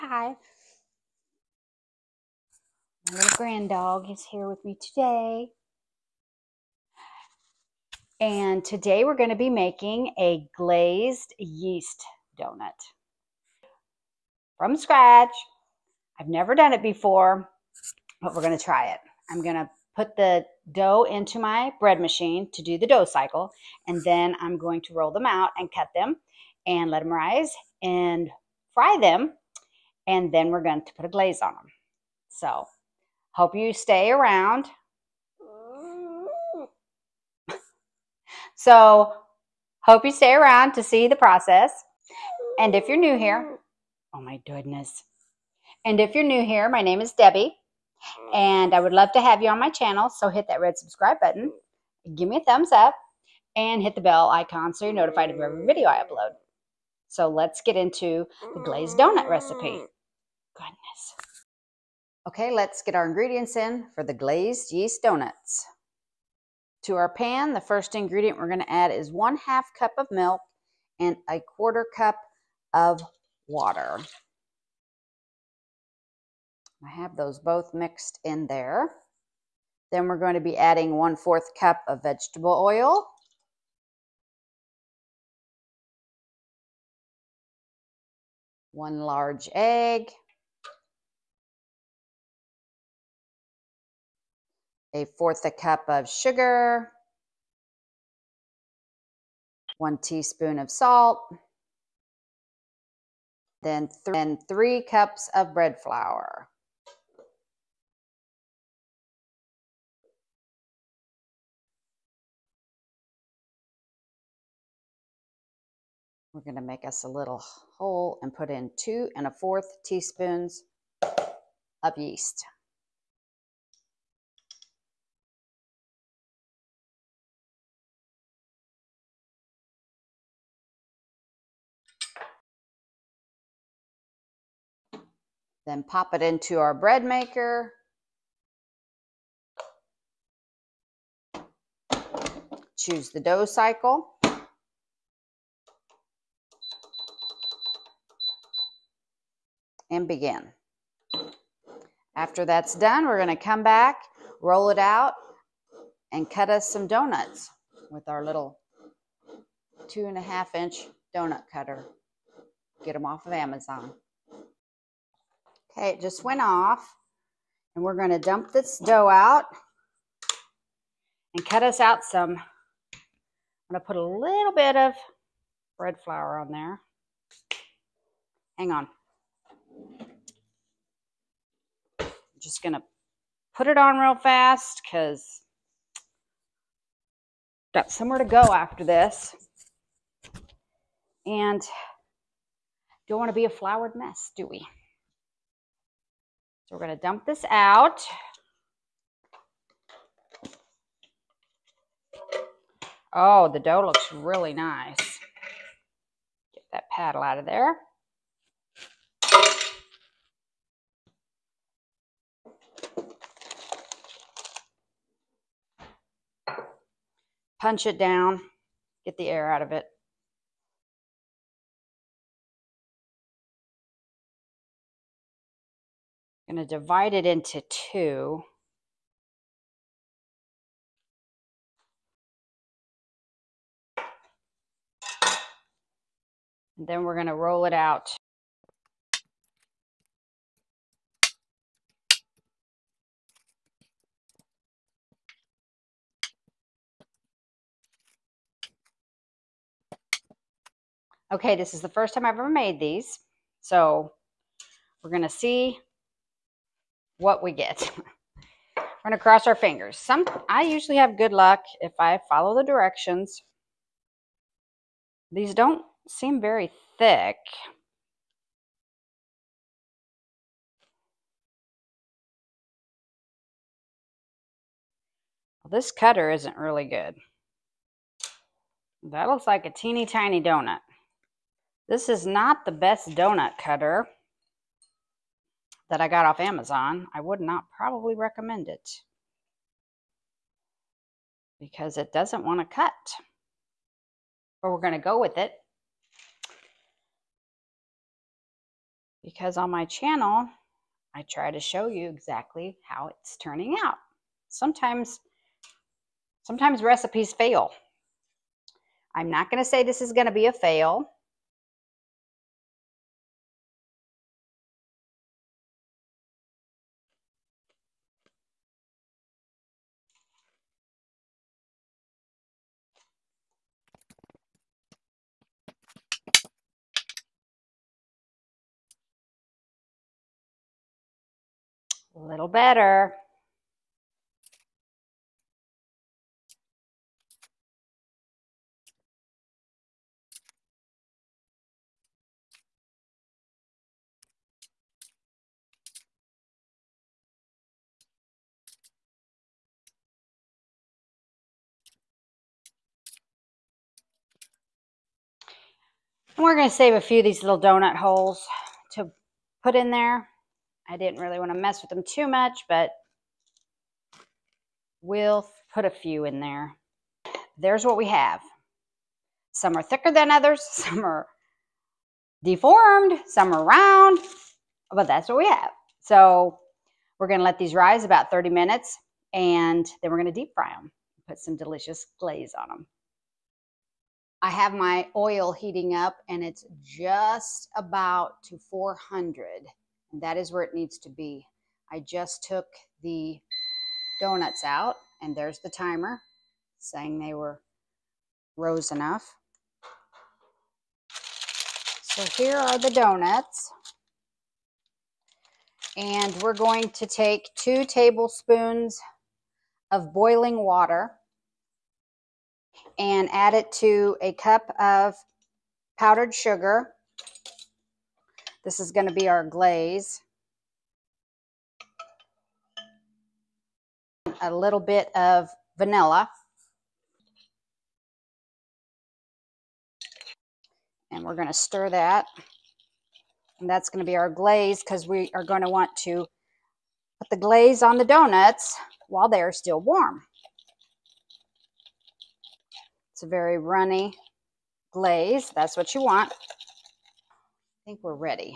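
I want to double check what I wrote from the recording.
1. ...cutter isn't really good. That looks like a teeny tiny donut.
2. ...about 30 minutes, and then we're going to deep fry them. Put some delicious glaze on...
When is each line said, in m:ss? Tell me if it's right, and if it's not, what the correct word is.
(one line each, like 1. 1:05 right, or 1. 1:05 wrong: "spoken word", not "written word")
1. 4:35 right
2. 6:18 right.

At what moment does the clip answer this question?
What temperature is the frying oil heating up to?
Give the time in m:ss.
6:28.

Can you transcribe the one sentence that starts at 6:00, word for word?
I didn't really want to mess with them too much, but we'll put a few in there.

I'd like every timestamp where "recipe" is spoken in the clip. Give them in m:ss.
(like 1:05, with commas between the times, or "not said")
0:59, 5:06.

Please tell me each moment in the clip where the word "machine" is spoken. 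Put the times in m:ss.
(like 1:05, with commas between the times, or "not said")
0:21.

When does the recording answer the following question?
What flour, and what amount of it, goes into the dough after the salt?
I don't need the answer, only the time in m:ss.
1:44.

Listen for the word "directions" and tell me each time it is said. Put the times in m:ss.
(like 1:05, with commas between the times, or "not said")
4:22.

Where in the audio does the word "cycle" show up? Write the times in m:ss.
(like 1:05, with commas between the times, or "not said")
0:23, 2:23.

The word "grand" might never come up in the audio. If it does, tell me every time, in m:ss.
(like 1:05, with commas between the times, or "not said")
0:03.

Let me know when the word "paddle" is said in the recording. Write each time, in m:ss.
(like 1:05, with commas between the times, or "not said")
3:26.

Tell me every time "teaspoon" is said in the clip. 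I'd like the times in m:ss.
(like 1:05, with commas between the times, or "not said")
1:39, 1:59.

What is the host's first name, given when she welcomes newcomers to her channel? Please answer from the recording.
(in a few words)
Debbie.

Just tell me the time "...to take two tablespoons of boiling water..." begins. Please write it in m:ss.
6:46.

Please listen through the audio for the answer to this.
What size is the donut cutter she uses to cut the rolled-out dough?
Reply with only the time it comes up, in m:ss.
2:39.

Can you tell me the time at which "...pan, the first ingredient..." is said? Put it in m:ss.
1:07.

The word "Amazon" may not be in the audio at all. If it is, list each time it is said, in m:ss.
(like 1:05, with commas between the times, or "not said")
2:43, 4:46.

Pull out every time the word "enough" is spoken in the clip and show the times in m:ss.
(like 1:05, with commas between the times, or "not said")
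6:38.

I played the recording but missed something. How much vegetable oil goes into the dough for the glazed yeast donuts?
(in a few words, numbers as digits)
1 cup.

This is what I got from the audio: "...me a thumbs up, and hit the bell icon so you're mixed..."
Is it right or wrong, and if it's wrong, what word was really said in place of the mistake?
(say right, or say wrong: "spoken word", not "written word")
wrong: "notified", not "mixed".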